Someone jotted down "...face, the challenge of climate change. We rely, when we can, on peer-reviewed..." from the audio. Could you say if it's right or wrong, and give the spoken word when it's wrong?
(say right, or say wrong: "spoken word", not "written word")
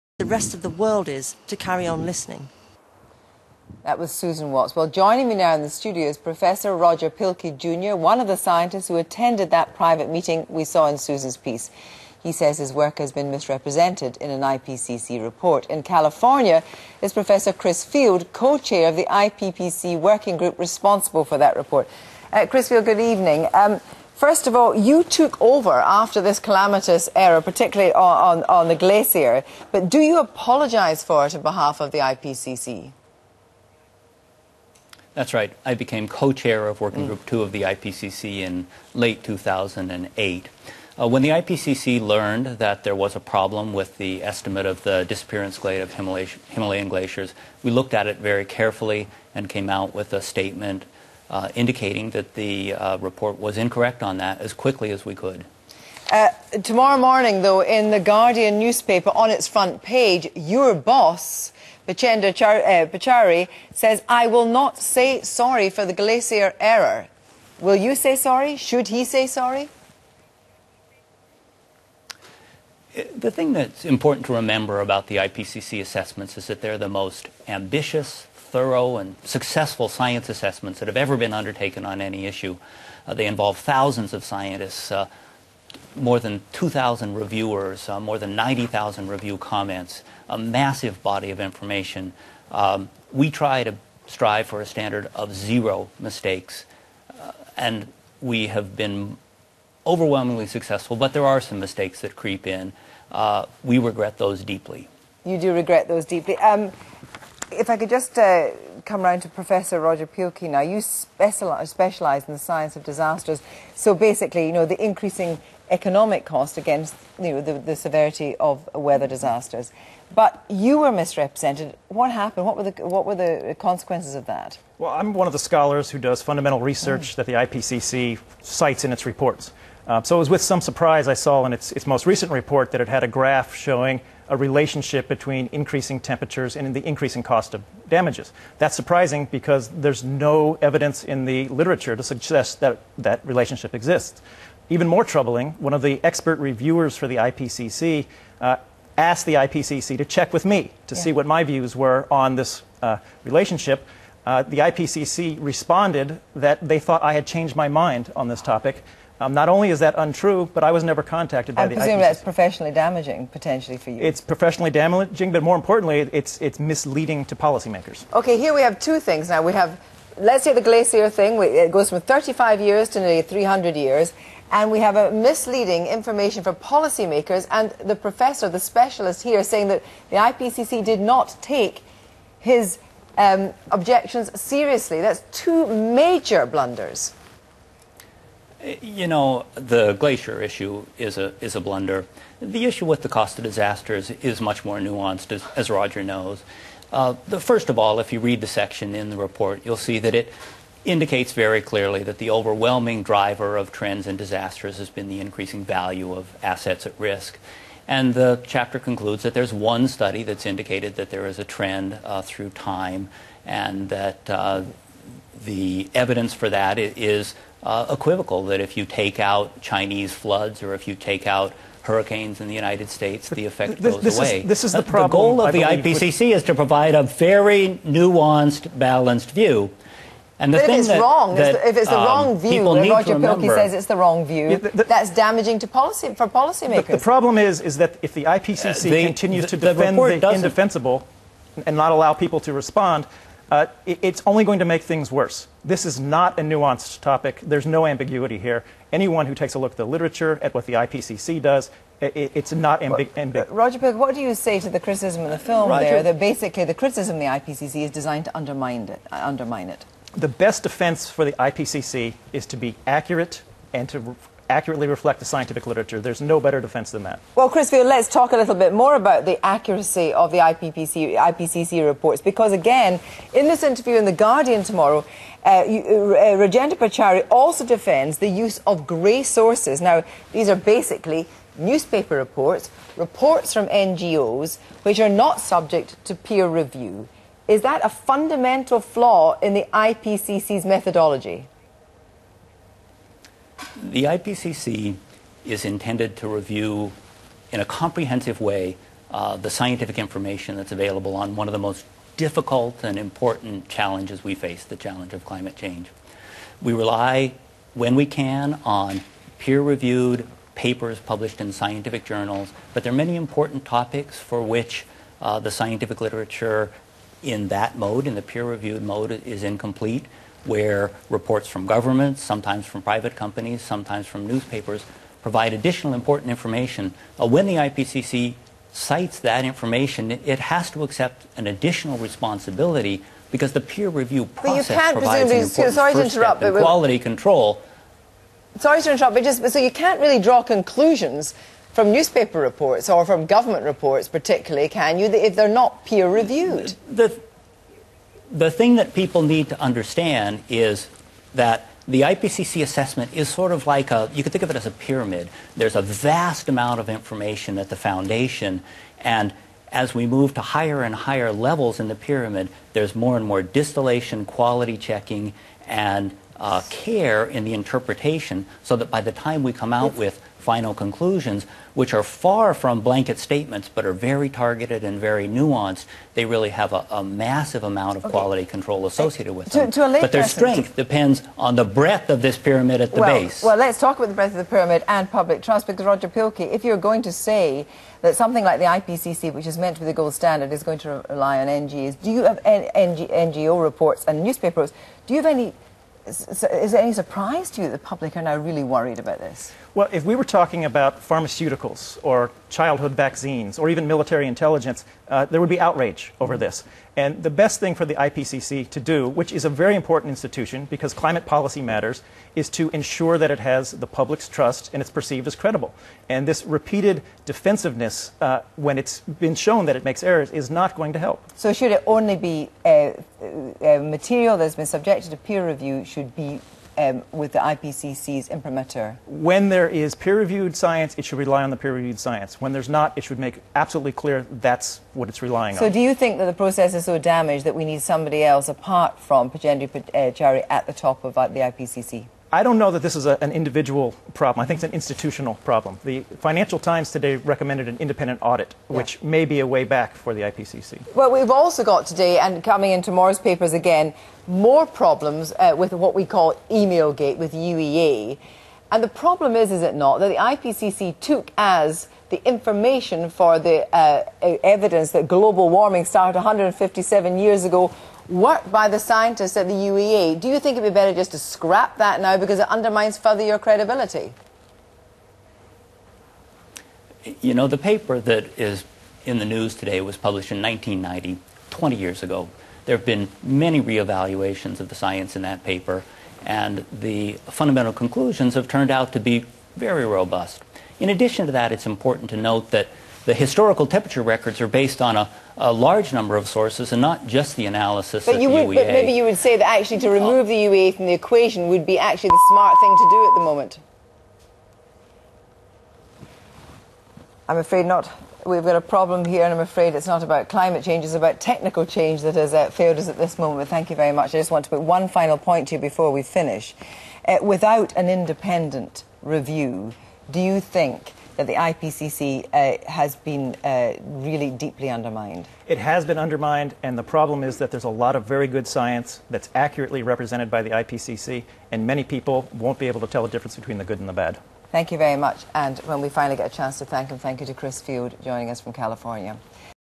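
right.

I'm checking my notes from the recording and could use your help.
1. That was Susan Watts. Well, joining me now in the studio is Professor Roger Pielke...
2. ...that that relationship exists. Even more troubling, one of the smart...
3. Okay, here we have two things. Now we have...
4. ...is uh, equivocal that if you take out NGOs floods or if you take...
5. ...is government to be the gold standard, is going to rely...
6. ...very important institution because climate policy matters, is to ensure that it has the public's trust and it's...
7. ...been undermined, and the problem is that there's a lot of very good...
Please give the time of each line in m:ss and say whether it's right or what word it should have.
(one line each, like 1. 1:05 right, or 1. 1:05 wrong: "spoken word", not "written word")
1. 0:03 right
2. 2:22 wrong: "expert", not "smart"
3. 2:48 right
4. 3:36 wrong: "Chinese", not "NGOs"
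5. 6:29 wrong: "meant", not "government"
6. 6:49 right
7. 8:45 right.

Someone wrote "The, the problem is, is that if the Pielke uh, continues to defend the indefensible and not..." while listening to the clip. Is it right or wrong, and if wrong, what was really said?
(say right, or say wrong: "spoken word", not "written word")
wrong: "IPCC", not "Pielke".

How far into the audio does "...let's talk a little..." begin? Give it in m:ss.
4:27.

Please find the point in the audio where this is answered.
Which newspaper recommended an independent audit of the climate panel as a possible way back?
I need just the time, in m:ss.
7:25.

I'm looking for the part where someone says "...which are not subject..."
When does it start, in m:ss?
4:44.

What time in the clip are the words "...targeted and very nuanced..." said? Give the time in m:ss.
6:14.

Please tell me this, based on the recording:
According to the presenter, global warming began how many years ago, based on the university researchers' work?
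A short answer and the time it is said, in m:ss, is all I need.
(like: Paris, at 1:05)
157 years, at 7:46.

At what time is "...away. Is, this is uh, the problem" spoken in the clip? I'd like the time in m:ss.
3:44.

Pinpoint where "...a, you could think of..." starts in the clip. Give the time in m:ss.
5:53.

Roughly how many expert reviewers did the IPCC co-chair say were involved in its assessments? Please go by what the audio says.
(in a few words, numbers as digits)
more than 2,000.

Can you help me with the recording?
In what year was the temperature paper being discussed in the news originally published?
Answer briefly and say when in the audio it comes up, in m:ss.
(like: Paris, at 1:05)
1990, at 8:00.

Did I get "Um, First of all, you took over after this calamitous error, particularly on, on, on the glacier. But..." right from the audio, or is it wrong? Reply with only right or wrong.
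right.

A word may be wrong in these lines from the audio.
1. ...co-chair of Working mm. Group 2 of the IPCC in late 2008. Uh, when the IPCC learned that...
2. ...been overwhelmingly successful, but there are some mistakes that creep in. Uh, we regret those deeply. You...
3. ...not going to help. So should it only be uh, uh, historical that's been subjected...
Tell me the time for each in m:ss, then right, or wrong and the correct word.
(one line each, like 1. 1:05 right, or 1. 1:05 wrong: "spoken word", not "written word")
1. 0:36 right
2. 1:38 right
3. 7:00 wrong: "material", not "historical".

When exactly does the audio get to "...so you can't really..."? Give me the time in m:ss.
5:39.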